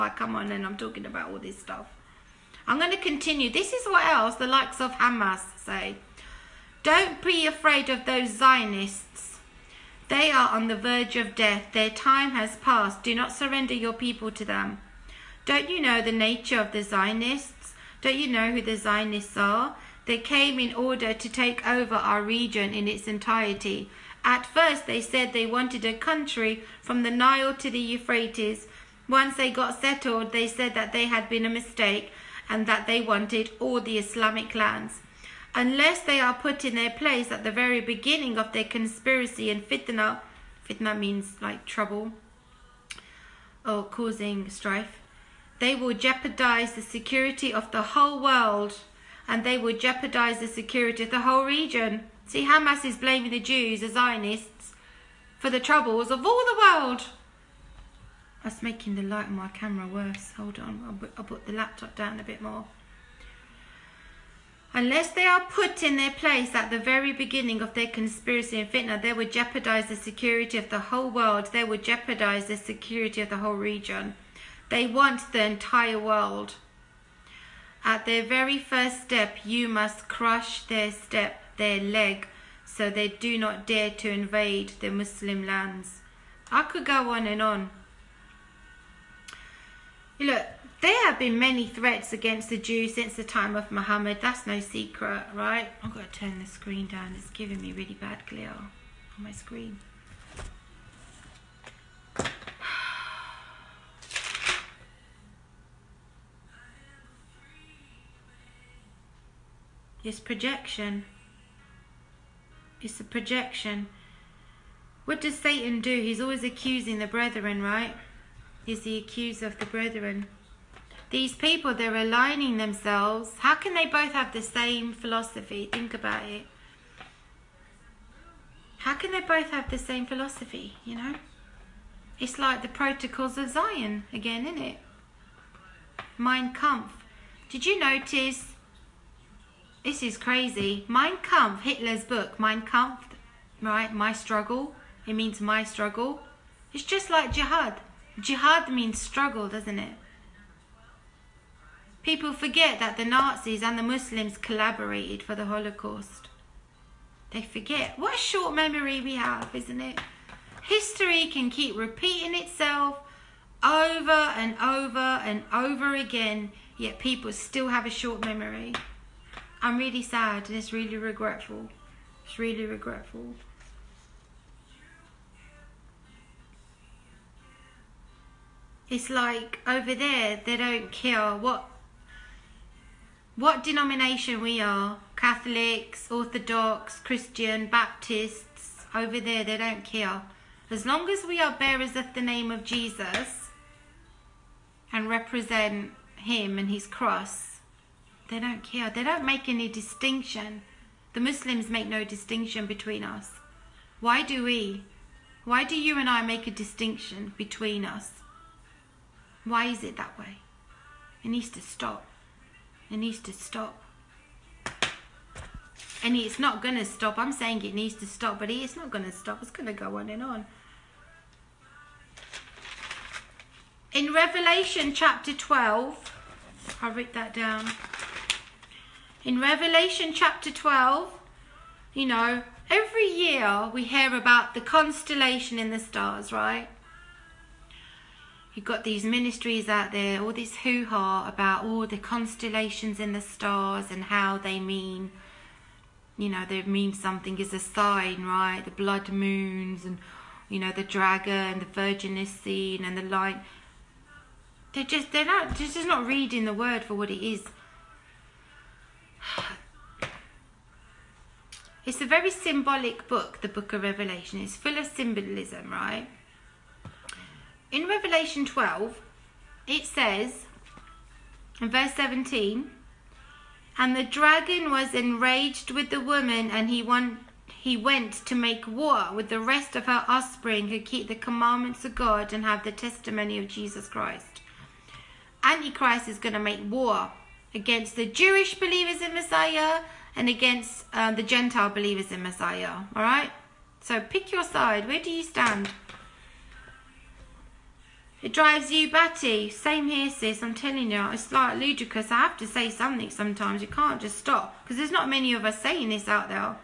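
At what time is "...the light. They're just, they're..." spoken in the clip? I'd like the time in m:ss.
4:12.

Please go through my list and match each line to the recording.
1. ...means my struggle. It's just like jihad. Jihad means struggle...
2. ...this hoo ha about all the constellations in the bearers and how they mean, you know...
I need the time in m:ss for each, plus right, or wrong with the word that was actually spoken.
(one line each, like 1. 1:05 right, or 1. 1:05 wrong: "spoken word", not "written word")
1. 2:25 right
2. 4:00 wrong: "stars", not "bearers".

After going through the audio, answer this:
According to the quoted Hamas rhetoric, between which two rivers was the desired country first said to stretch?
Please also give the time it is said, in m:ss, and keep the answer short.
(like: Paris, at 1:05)
The Nile to the Euphrates, at 0:27.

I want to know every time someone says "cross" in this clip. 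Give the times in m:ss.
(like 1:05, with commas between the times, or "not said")
3:16.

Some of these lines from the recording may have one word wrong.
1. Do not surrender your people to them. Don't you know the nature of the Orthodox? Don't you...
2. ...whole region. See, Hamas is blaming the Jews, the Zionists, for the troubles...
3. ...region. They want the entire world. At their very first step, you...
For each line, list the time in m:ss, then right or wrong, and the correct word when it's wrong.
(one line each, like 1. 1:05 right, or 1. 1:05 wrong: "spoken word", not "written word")
1. 0:13 wrong: "Zionists", not "Orthodox"
2. 0:51 right
3. 1:13 right.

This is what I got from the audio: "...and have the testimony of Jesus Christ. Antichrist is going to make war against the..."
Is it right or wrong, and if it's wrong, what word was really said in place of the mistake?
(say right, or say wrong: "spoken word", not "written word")
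right.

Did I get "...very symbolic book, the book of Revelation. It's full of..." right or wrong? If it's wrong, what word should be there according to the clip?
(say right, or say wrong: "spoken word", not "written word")
right.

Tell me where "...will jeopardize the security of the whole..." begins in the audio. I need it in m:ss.
0:45.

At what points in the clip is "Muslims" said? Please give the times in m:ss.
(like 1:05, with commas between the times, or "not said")
1:24, 2:33, 3:21.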